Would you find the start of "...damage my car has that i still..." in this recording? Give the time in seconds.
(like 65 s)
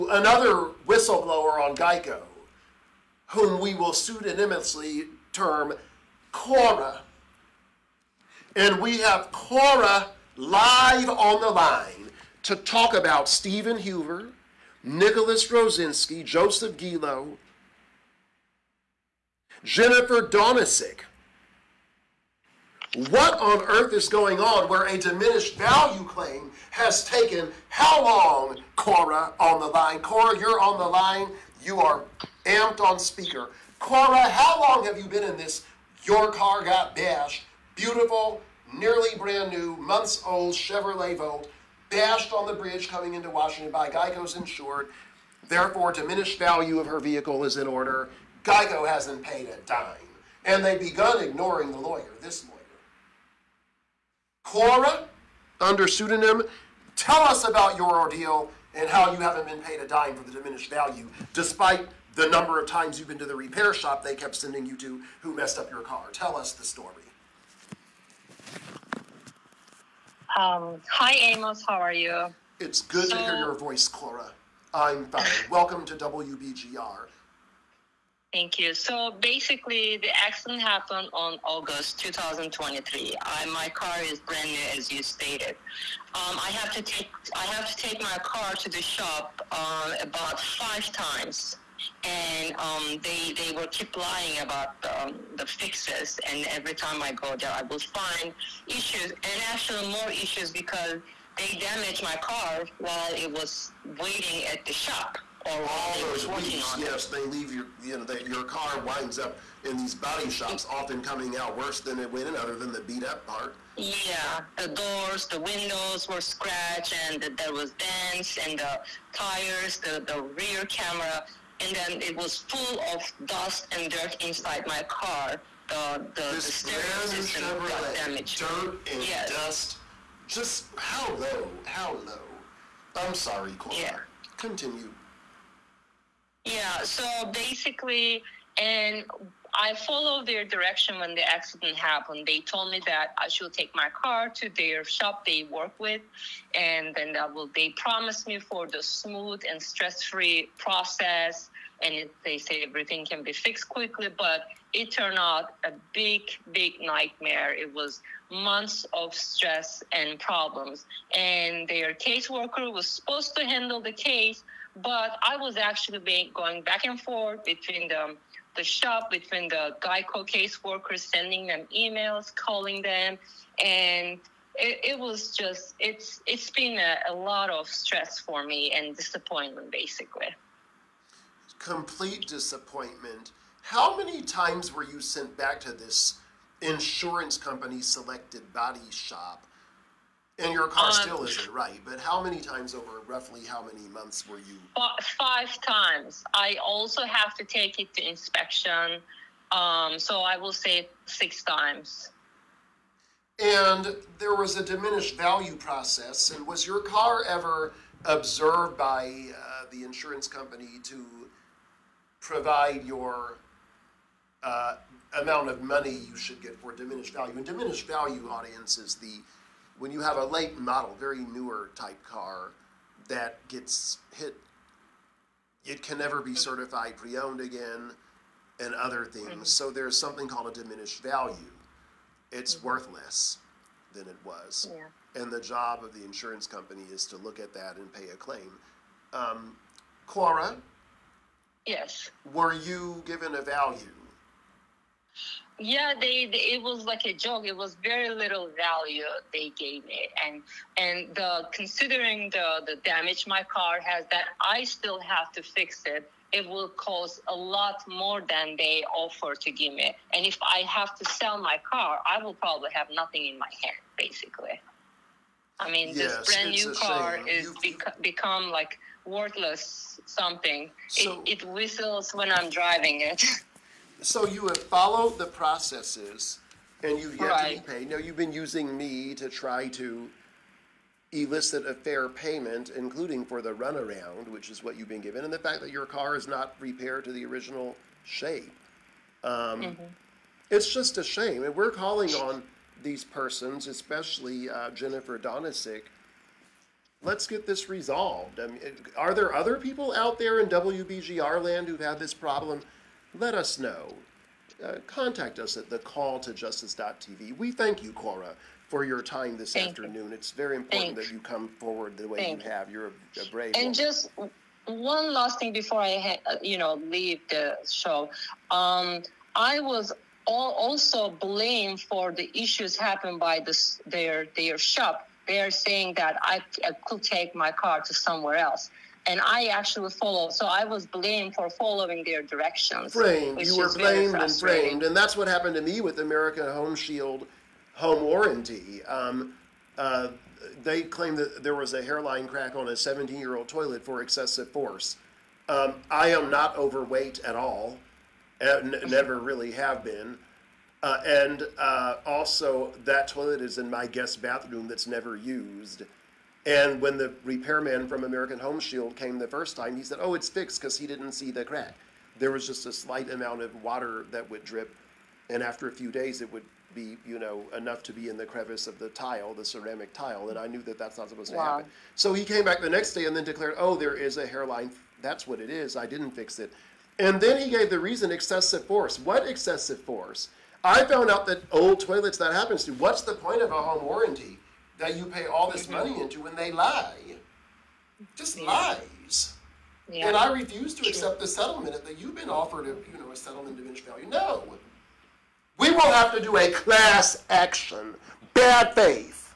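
252 s.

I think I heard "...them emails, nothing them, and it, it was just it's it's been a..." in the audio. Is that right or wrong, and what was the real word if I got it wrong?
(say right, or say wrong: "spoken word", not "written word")
wrong: "calling", not "nothing".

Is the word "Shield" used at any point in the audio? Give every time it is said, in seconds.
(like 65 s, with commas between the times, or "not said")
336 s, 358 s.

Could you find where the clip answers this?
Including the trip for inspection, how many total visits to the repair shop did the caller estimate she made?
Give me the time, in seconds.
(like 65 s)
201 s.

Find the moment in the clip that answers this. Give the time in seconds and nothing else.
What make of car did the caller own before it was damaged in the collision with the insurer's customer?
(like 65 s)
40 s.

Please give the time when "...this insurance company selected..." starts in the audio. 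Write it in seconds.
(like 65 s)
185 s.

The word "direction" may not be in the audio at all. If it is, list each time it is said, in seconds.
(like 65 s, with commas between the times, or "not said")
140 s, 332 s.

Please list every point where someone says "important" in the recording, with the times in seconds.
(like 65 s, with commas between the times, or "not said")
310 s.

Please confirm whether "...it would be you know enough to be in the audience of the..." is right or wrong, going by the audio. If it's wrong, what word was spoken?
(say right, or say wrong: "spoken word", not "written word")
wrong: "crevice", not "audience".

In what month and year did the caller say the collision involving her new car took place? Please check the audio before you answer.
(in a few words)
August 2023.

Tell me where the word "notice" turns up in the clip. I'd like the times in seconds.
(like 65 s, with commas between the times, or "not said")
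not said.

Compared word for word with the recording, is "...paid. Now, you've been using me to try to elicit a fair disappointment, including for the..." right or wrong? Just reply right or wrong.
wrong.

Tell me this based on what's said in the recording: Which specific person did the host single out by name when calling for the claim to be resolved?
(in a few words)
Jennifer Donisic.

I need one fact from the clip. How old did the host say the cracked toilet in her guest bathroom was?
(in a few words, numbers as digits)
17 years.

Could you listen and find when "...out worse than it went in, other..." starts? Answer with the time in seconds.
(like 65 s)
111 s.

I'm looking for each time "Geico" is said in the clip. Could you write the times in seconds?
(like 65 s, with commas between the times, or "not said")
1 s, 43 s, 48 s, 169 s.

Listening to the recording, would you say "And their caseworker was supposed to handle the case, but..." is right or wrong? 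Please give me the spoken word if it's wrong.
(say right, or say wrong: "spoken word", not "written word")
right.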